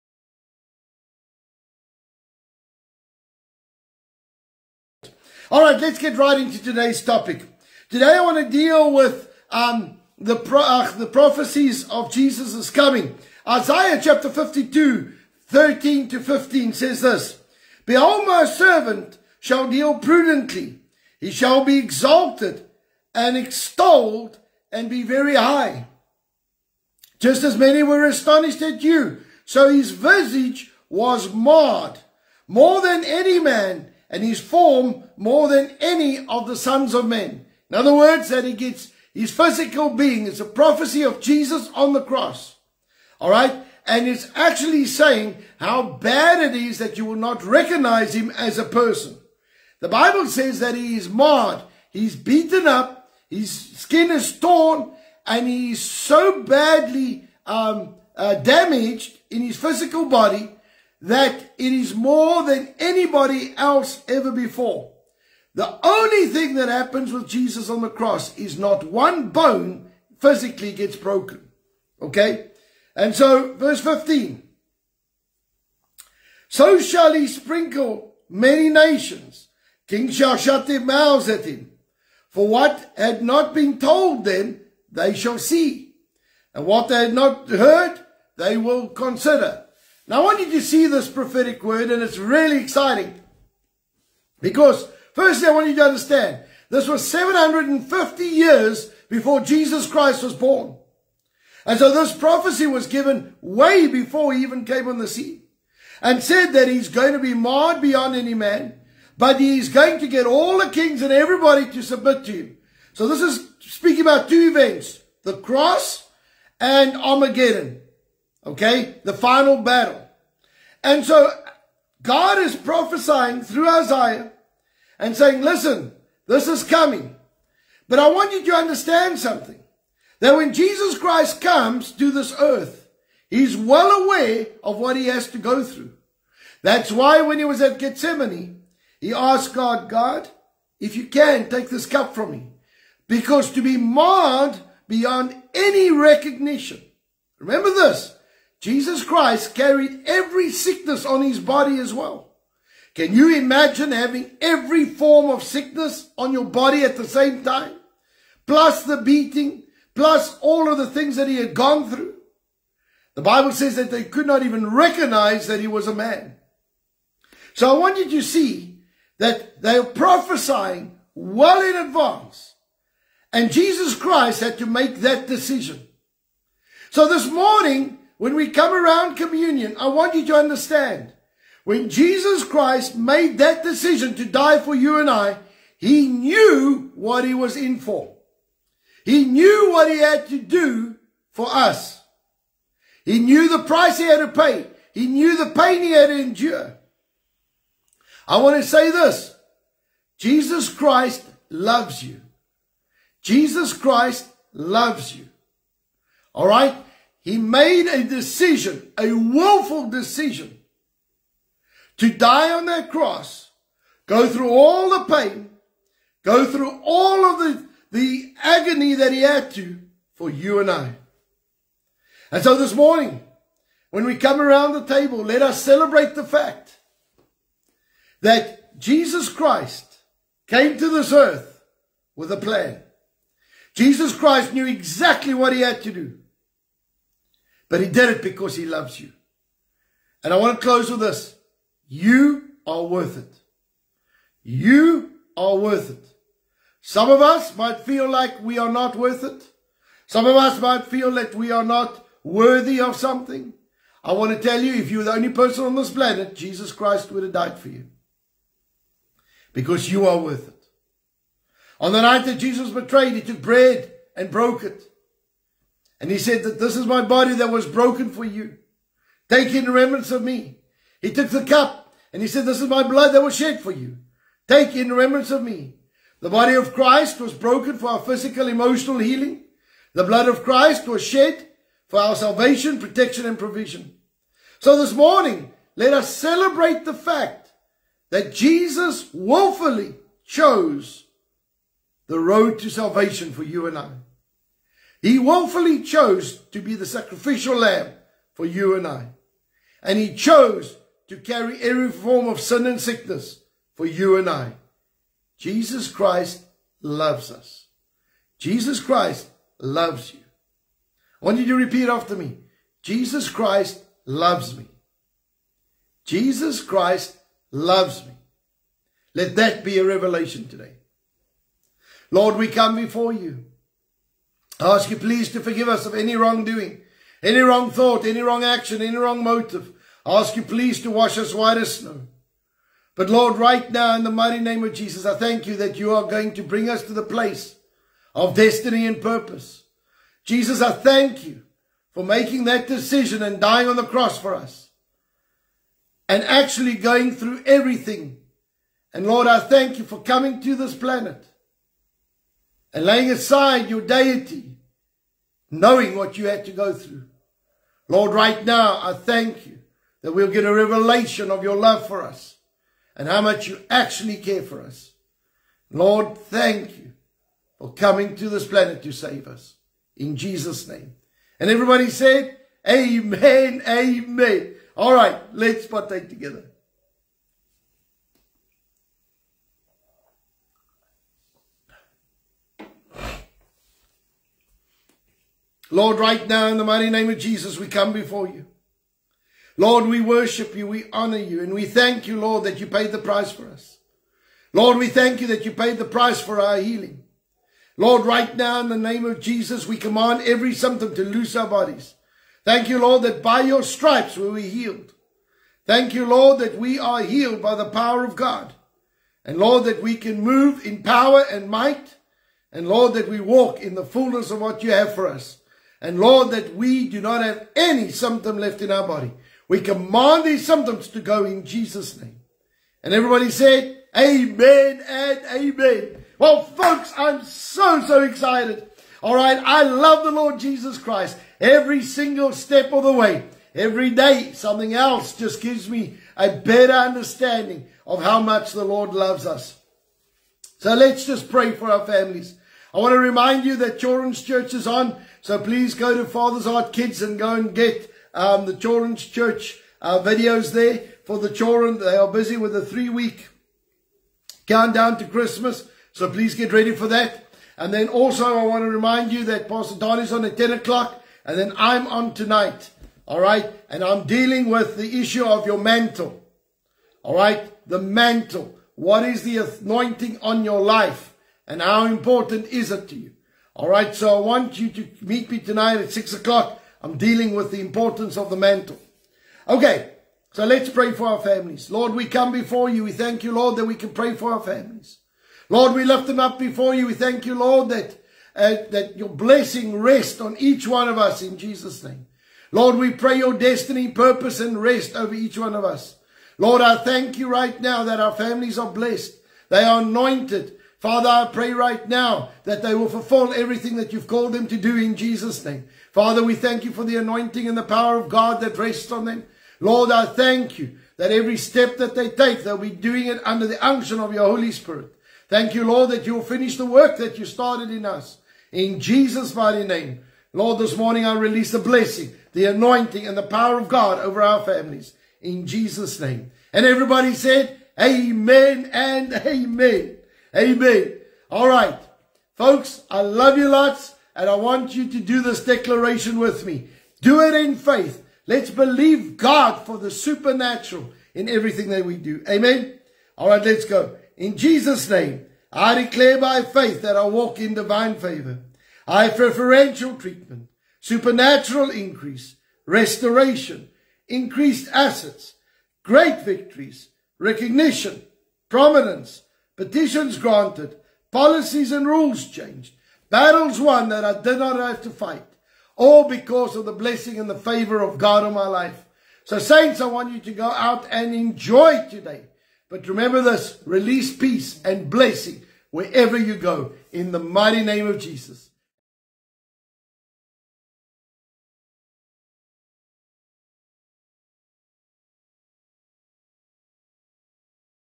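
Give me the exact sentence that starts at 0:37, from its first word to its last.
In other words, that he gets his physical being.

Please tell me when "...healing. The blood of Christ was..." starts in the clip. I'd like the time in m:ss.
4:38.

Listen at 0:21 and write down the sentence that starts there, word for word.
He shall be exalted and extolled and be very high.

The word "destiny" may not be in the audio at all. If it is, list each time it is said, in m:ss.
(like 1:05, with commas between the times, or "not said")
5:38, 8:13.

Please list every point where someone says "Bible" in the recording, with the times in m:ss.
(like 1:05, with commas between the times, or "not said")
0:49, 2:43.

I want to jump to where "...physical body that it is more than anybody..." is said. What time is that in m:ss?
0:59.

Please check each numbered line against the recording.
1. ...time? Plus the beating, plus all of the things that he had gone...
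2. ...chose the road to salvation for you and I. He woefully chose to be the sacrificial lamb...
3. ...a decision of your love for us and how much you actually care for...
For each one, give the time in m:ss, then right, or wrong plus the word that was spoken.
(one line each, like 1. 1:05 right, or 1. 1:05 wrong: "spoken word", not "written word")
1. 2:37 right
2. 4:50 right
3. 6:00 wrong: "revelation", not "decision".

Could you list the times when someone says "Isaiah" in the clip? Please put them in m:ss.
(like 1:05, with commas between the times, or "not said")
0:13, 2:03.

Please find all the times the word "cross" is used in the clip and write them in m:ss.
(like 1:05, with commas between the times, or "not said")
0:42, 1:07, 1:55, 3:32, 5:43.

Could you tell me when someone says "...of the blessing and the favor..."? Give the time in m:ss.
9:26.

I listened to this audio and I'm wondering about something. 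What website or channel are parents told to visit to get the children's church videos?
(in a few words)
Father's Heart Kids.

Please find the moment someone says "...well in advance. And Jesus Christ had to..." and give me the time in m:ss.
2:51.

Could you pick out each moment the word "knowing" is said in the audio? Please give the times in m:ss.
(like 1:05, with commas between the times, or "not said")
5:55.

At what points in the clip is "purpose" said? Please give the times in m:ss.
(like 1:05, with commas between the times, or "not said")
5:39, 8:13.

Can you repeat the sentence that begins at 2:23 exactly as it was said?
Because to be marred beyond any recognition.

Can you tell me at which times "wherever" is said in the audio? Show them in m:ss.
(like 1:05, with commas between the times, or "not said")
9:35.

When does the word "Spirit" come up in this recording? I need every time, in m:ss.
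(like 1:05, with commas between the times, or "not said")
8:34.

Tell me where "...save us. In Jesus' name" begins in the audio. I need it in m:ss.
6:08.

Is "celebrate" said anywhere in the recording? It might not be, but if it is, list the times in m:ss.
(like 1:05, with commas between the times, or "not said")
3:45, 4:46.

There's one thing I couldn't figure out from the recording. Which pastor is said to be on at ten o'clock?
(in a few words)
Pastor Don.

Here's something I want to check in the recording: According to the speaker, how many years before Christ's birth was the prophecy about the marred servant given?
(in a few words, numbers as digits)
750.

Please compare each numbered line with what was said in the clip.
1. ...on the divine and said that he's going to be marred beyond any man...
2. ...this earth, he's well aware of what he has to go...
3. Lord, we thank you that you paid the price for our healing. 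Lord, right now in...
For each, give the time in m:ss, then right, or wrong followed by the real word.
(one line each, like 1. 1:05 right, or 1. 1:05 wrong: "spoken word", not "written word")
1. 1:44 wrong: "scene", not "divine"
2. 2:12 right
3. 6:34 right.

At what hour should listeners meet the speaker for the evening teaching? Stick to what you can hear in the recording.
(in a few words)
6 o'clock.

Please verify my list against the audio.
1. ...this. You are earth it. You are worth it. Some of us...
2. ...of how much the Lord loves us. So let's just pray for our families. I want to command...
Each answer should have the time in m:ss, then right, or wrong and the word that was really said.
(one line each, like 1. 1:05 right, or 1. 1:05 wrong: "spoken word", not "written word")
1. 4:00 wrong: "worth", not "earth"
2. 7:17 wrong: "remind", not "command".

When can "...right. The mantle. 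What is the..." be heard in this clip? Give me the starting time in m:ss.
7:47.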